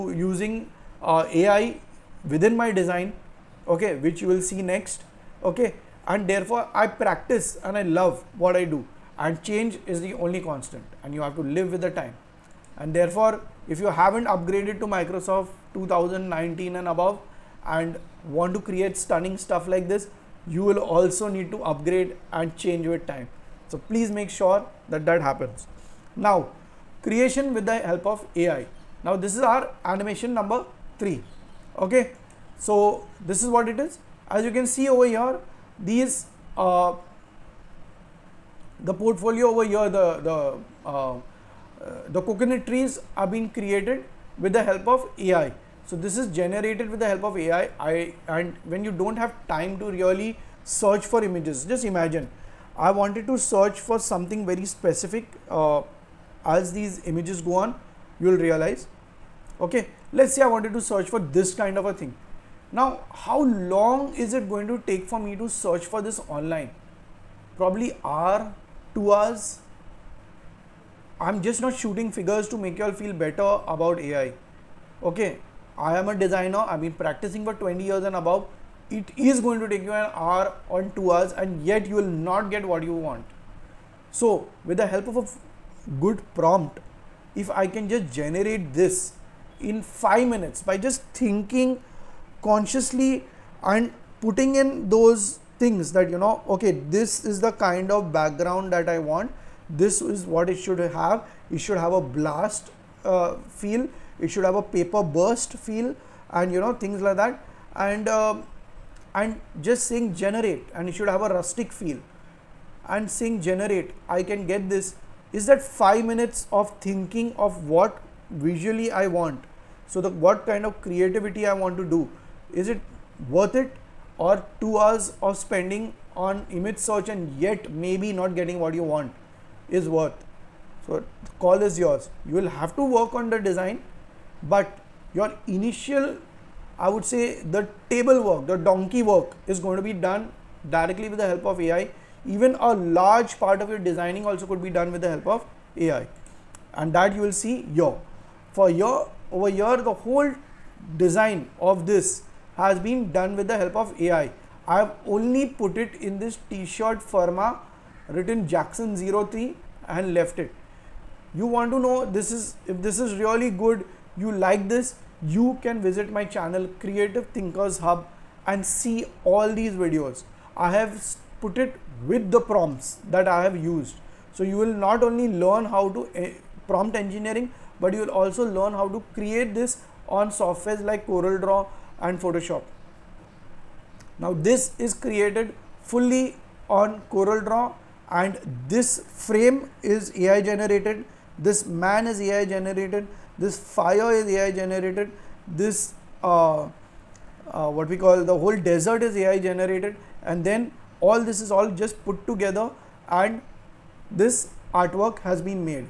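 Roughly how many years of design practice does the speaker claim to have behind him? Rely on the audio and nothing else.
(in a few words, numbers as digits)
20.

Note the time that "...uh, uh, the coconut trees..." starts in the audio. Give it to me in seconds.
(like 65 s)
40 s.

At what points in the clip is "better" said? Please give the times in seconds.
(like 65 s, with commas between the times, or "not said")
73 s.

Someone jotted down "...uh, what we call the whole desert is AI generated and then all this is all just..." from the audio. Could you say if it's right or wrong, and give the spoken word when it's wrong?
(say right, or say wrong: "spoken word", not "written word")
right.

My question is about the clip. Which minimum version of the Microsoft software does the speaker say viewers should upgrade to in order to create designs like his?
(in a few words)
2019.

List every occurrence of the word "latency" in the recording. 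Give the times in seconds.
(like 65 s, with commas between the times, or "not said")
not said.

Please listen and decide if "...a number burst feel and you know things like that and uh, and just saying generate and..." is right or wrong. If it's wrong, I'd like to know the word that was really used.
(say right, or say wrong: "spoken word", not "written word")
wrong: "paper", not "number".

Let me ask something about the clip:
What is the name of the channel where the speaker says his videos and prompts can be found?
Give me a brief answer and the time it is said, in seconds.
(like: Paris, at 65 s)
Creative Thinkers Hub, at 166 s.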